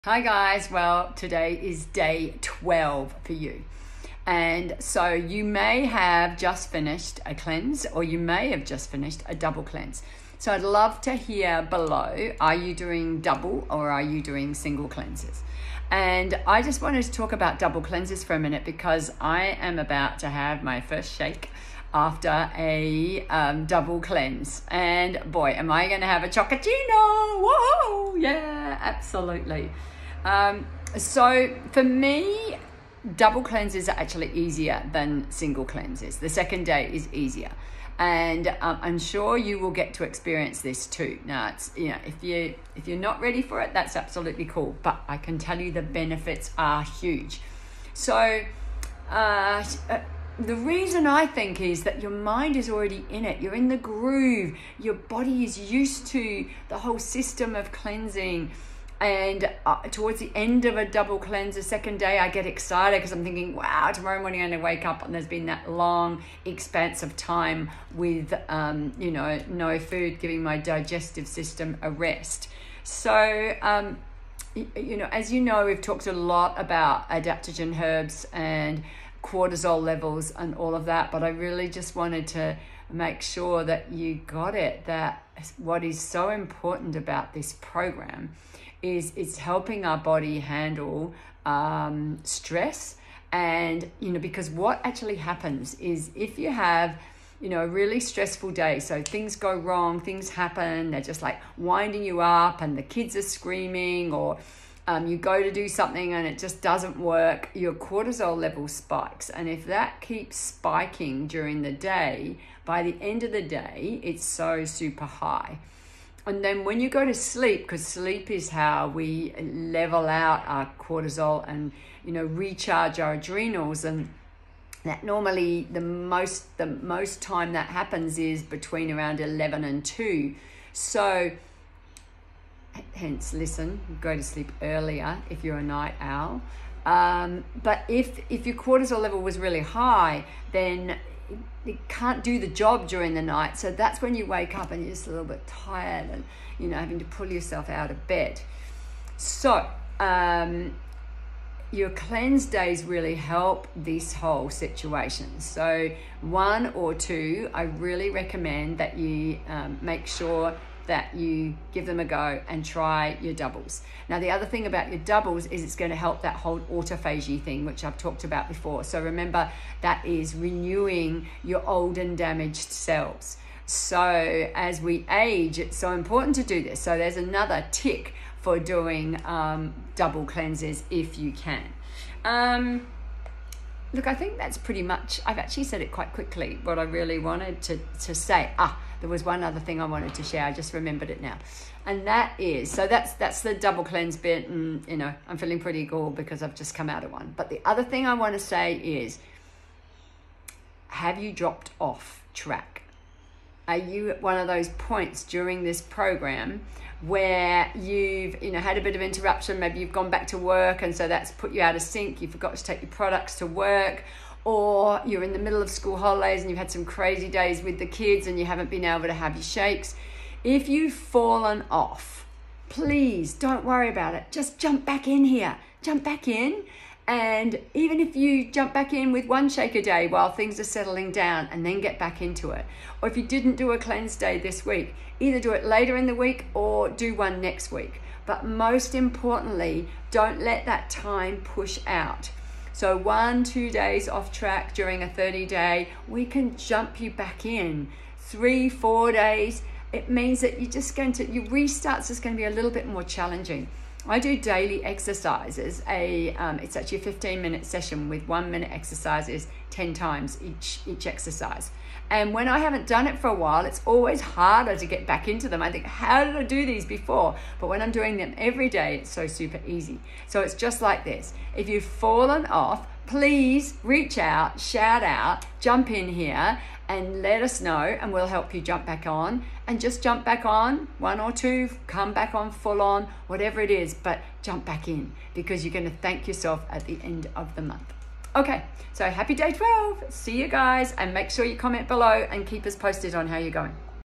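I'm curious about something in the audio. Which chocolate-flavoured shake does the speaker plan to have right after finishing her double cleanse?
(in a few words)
Chocolatino.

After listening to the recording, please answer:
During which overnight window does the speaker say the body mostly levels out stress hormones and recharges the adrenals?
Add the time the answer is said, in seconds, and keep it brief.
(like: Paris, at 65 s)
11 and 2, at 128 s.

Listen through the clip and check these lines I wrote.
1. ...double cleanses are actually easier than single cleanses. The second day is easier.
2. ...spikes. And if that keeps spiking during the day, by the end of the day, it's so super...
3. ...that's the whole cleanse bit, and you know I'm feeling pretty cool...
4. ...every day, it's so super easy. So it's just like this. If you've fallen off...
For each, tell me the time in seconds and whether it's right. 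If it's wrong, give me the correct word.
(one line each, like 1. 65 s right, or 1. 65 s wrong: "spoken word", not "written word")
1. 33 s right
2. 108 s right
3. 193 s wrong: "double", not "whole"
4. 268 s right.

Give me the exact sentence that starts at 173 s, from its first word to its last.
So as we age, it's so important to do this.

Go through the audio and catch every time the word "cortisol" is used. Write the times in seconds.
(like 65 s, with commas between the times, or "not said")
79 s, 107 s, 120 s, 138 s.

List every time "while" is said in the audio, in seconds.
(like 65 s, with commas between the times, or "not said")
230 s, 263 s.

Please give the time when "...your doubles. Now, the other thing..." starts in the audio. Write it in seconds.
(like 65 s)
163 s.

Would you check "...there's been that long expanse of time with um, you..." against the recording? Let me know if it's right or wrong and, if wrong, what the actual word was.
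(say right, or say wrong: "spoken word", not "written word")
right.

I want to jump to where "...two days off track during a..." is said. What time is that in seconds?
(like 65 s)
243 s.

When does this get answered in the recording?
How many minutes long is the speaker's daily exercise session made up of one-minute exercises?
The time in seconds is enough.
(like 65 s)
257 s.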